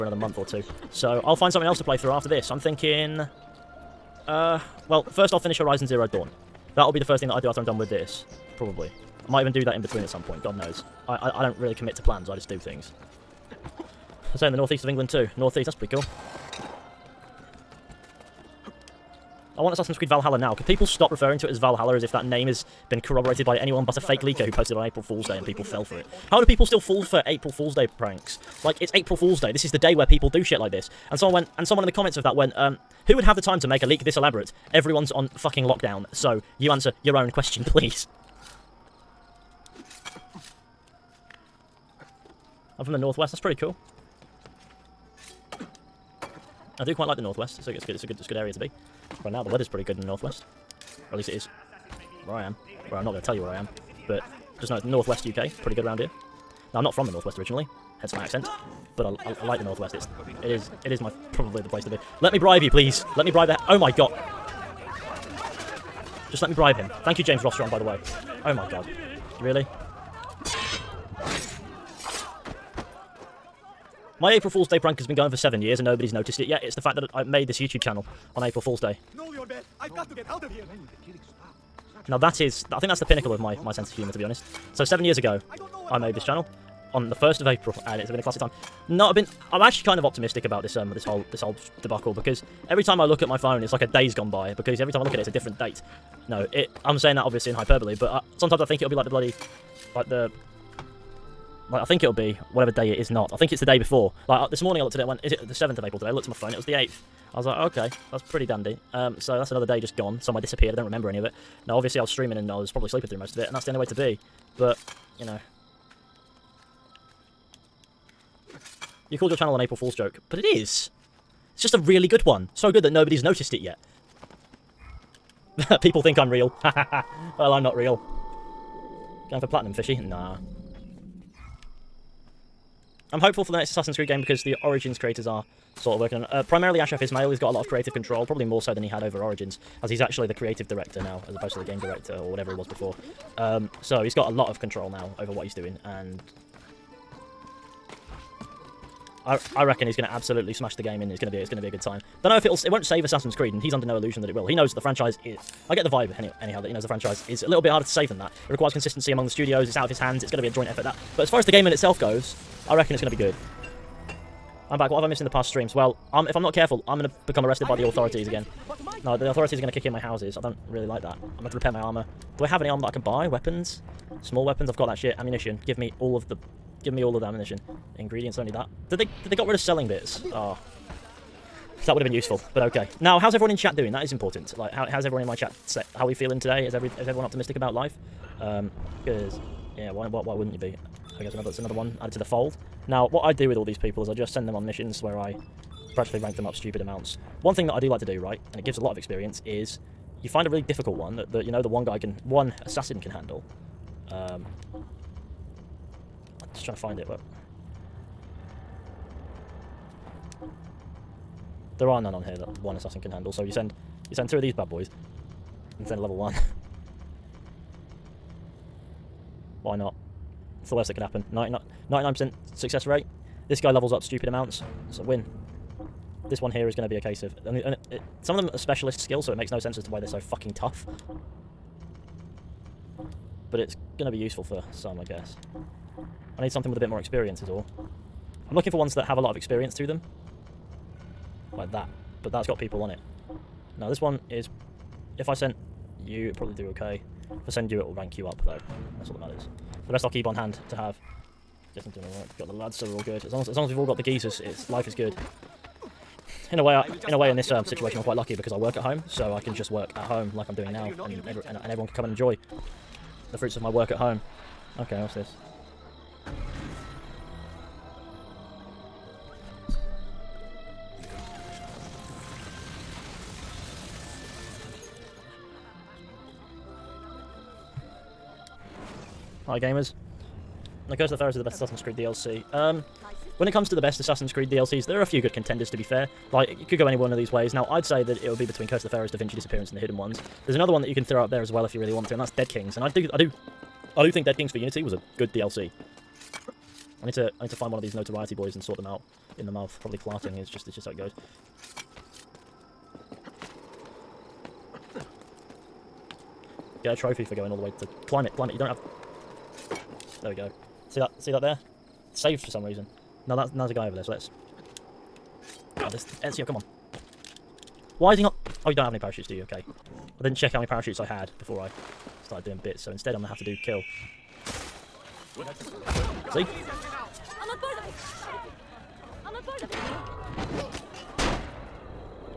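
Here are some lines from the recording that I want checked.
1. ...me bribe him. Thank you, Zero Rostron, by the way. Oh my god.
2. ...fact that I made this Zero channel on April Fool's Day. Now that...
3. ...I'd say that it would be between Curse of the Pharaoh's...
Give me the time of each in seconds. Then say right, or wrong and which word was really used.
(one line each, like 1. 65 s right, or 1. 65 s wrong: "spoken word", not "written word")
1. 66 s wrong: "James", not "Zero"
2. 76 s wrong: "YouTube", not "Zero"
3. 287 s right.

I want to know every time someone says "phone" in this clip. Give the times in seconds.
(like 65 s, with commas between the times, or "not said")
93 s, 106 s.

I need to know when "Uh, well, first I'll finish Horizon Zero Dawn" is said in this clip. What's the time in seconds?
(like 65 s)
4 s.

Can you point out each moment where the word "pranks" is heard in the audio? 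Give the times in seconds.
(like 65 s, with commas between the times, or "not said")
27 s, 74 s.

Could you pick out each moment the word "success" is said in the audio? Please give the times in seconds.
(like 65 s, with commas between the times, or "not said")
222 s.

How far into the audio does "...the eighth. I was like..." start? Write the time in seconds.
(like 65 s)
106 s.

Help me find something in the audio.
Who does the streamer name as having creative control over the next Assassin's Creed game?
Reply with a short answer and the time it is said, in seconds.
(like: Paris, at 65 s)
Ashraf Ismail, at 136 s.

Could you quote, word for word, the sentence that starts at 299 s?
Probably clarting is just, it's just how it goes.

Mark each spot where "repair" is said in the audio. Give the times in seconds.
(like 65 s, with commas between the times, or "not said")
171 s.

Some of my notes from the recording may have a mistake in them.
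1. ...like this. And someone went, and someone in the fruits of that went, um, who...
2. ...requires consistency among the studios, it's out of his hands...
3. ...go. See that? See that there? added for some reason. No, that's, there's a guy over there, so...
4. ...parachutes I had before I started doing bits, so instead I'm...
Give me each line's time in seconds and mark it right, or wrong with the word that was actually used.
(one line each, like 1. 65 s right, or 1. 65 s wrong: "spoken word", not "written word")
1. 30 s wrong: "comments", not "fruits"
2. 158 s right
3. 310 s wrong: "saved", not "added"
4. 320 s right.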